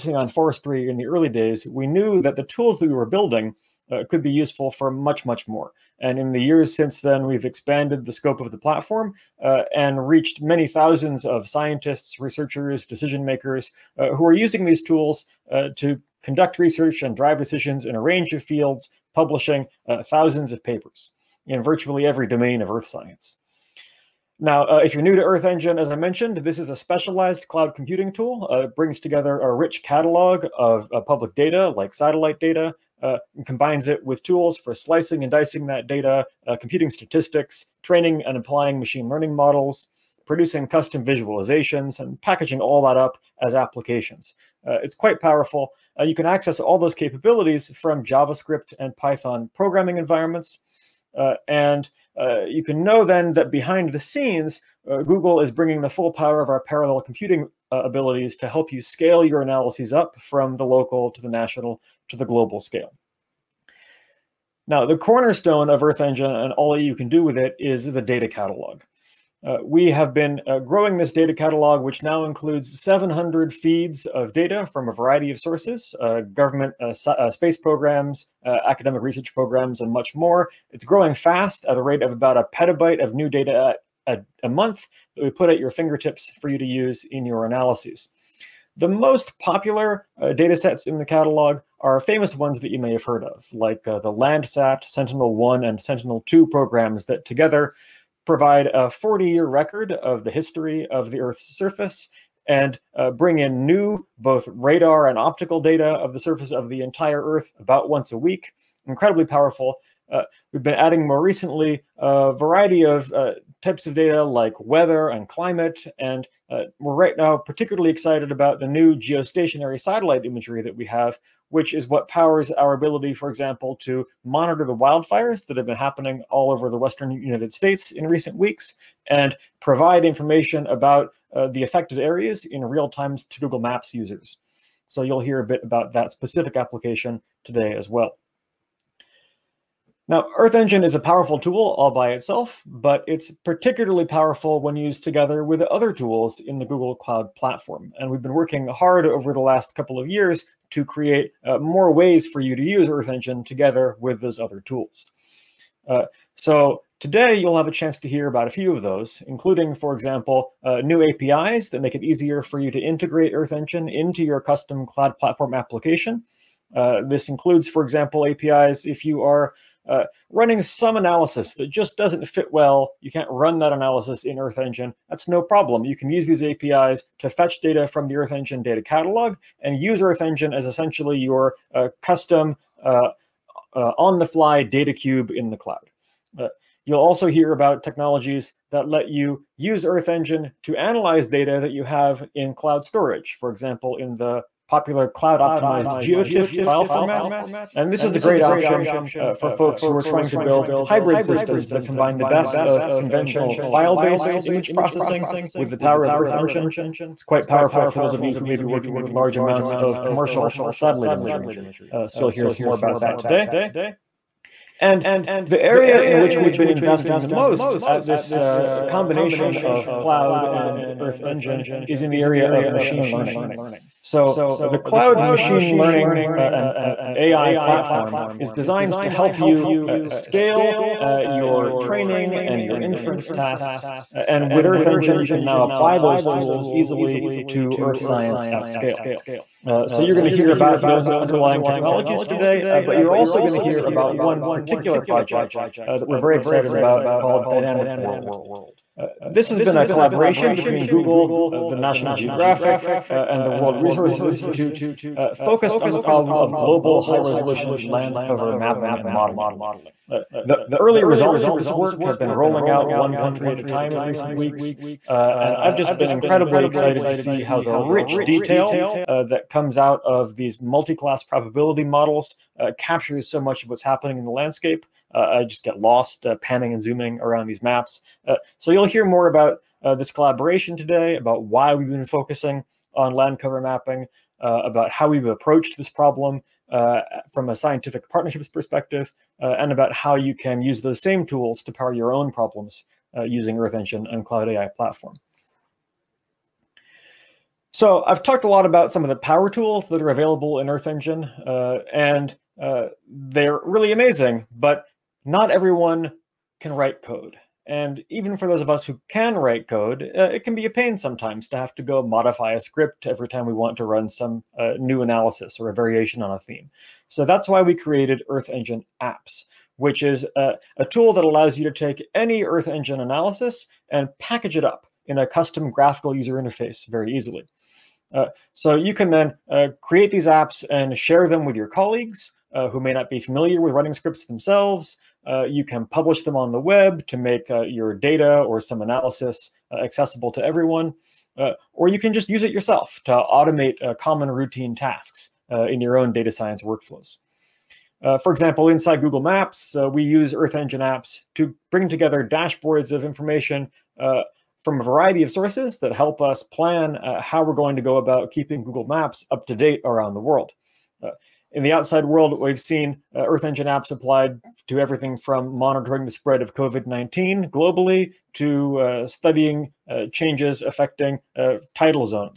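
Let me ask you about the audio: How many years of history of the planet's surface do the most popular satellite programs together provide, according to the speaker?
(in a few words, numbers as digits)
40 years.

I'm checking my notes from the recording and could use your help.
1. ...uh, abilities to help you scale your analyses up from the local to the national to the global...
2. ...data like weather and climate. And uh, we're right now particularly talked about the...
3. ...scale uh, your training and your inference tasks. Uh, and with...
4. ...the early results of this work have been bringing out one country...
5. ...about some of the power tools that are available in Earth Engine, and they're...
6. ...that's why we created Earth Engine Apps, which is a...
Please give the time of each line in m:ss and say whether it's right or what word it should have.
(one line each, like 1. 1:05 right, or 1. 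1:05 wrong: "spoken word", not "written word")
1. 0:57 right
2. 1:53 wrong: "excited", not "talked"
3. 3:50 right
4. 4:20 wrong: "rolling", not "bringing"
5. 4:58 right
6. 5:17 right.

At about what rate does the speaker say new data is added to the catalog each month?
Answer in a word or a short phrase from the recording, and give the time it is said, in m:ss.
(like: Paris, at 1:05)
About a petabyte, at 1:22.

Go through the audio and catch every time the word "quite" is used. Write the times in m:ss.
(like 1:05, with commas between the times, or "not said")
0:44, 3:27.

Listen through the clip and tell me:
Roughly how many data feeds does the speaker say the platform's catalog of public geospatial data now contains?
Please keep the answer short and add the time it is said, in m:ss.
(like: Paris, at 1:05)
700, at 1:12.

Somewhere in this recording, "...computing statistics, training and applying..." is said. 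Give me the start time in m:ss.
0:36.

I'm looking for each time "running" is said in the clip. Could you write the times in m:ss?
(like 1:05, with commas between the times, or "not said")
2:50, 5:33.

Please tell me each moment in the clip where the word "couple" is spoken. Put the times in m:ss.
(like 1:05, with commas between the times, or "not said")
2:29.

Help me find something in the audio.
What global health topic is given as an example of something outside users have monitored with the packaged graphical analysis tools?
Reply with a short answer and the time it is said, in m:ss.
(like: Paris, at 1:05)
COVID-19, at 6:06.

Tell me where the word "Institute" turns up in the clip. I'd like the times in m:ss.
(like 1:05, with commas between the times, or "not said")
4:14.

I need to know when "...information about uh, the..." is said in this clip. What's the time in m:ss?
2:10.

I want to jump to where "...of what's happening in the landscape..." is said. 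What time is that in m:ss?
4:33.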